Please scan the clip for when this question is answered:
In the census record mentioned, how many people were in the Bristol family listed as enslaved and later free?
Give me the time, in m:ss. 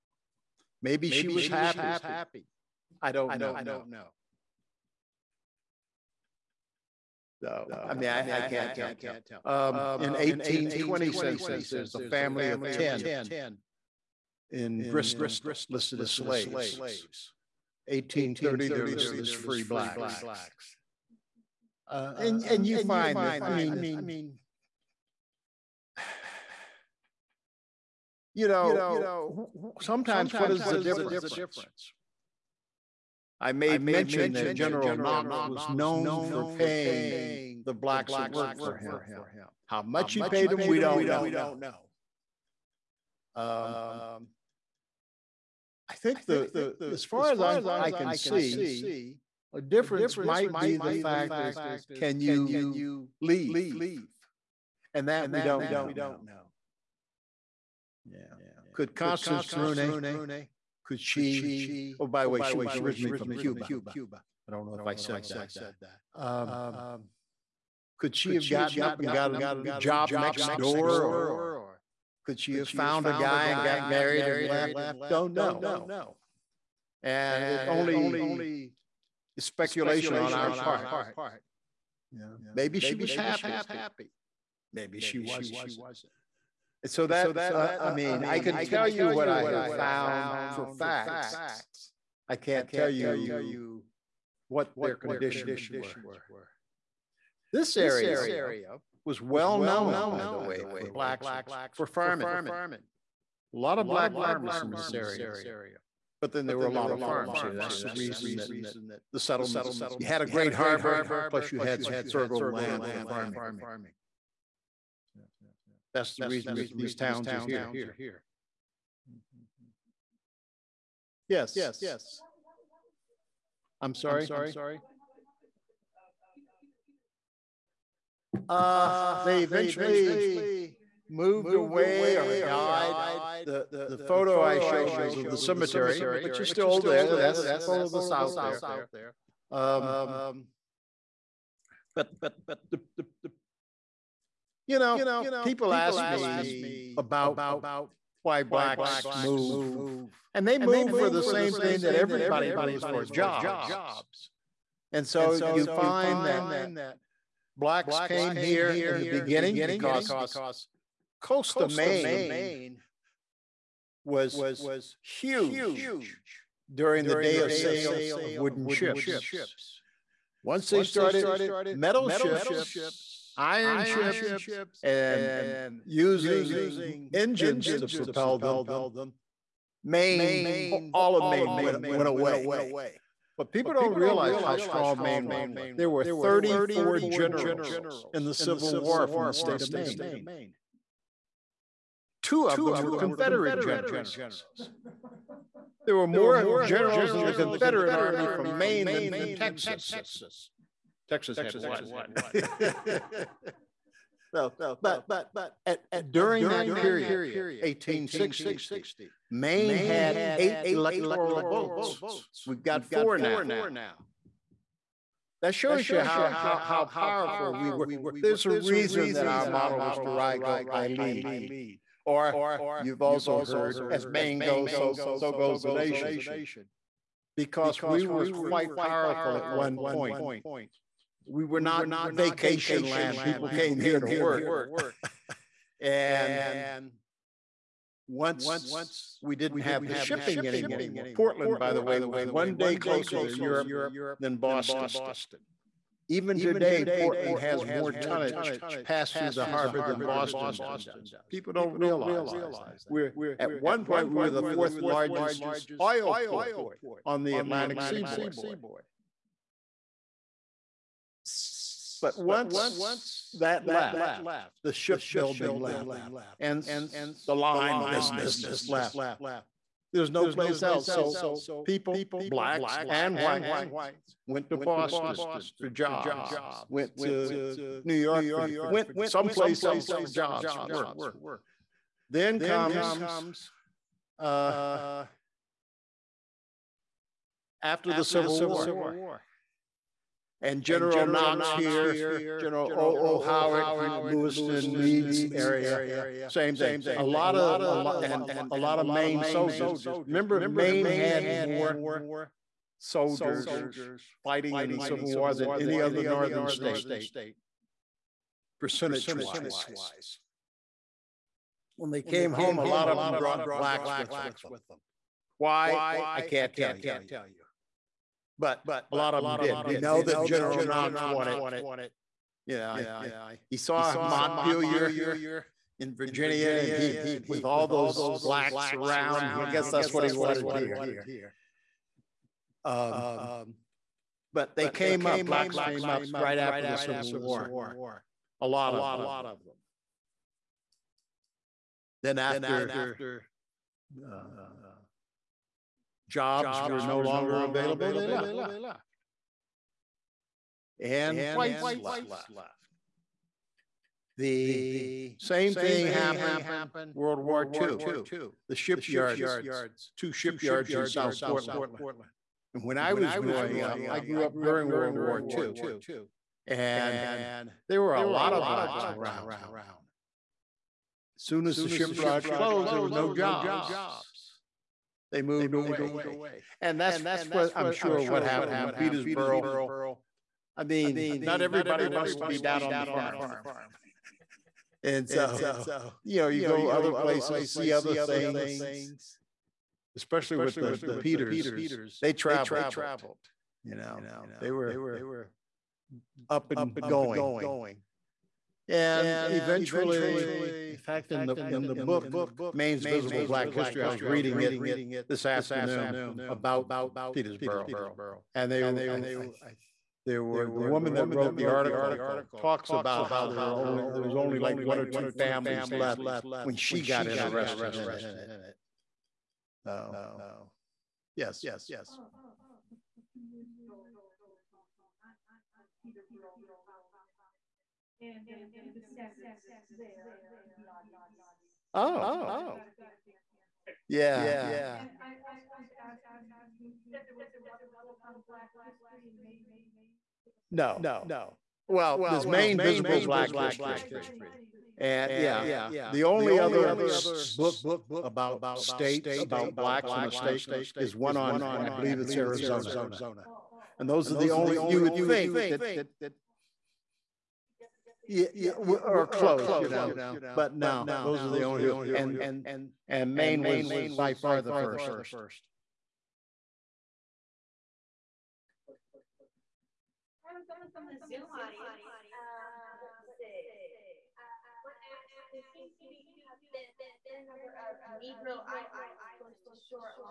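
0:11.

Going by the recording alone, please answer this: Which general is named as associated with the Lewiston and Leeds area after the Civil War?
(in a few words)
O.O. Howard.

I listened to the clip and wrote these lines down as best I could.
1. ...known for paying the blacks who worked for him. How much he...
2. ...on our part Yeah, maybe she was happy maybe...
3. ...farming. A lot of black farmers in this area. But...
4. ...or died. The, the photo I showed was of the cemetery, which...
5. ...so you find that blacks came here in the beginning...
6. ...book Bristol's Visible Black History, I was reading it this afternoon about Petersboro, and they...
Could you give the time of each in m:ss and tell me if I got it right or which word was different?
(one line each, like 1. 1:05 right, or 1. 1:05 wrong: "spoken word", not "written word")
1. 0:35 right
2. 1:20 right
3. 1:41 right
4. 2:12 right
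5. 2:35 right
6. 6:41 wrong: "Maine", not "Bristol".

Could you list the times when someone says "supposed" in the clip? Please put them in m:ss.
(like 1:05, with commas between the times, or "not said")
not said.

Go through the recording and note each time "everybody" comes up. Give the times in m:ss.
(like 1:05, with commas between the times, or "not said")
2:31, 6:21.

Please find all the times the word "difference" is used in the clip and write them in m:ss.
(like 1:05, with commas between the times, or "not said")
0:30, 0:49.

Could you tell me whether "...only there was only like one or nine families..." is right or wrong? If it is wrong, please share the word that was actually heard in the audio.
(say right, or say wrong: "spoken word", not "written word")
wrong: "two", not "nine".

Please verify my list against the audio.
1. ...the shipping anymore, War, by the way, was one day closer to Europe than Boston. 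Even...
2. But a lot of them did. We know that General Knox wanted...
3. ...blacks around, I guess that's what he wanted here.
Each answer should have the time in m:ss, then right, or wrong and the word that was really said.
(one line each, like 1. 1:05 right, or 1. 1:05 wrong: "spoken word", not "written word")
1. 3:59 wrong: "Portland", not "War"
2. 5:18 right
3. 5:28 right.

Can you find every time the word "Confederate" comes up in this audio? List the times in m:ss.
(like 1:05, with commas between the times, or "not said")
3:12, 3:17.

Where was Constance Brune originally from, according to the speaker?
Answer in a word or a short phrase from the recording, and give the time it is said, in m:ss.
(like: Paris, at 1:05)
Cuba, at 1:03.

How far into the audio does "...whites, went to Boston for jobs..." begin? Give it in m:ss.
4:33.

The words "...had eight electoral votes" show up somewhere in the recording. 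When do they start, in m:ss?
3:29.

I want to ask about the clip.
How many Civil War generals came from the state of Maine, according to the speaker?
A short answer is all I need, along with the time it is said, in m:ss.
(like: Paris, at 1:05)
34, at 3:06.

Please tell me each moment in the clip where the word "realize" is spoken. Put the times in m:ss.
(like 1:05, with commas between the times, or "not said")
3:03, 4:11.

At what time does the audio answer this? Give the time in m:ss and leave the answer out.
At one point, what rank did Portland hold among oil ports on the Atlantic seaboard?
4:14.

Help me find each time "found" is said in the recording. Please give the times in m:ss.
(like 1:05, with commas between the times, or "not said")
1:12, 1:29.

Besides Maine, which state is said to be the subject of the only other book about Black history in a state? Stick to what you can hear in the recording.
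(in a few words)
Arizona.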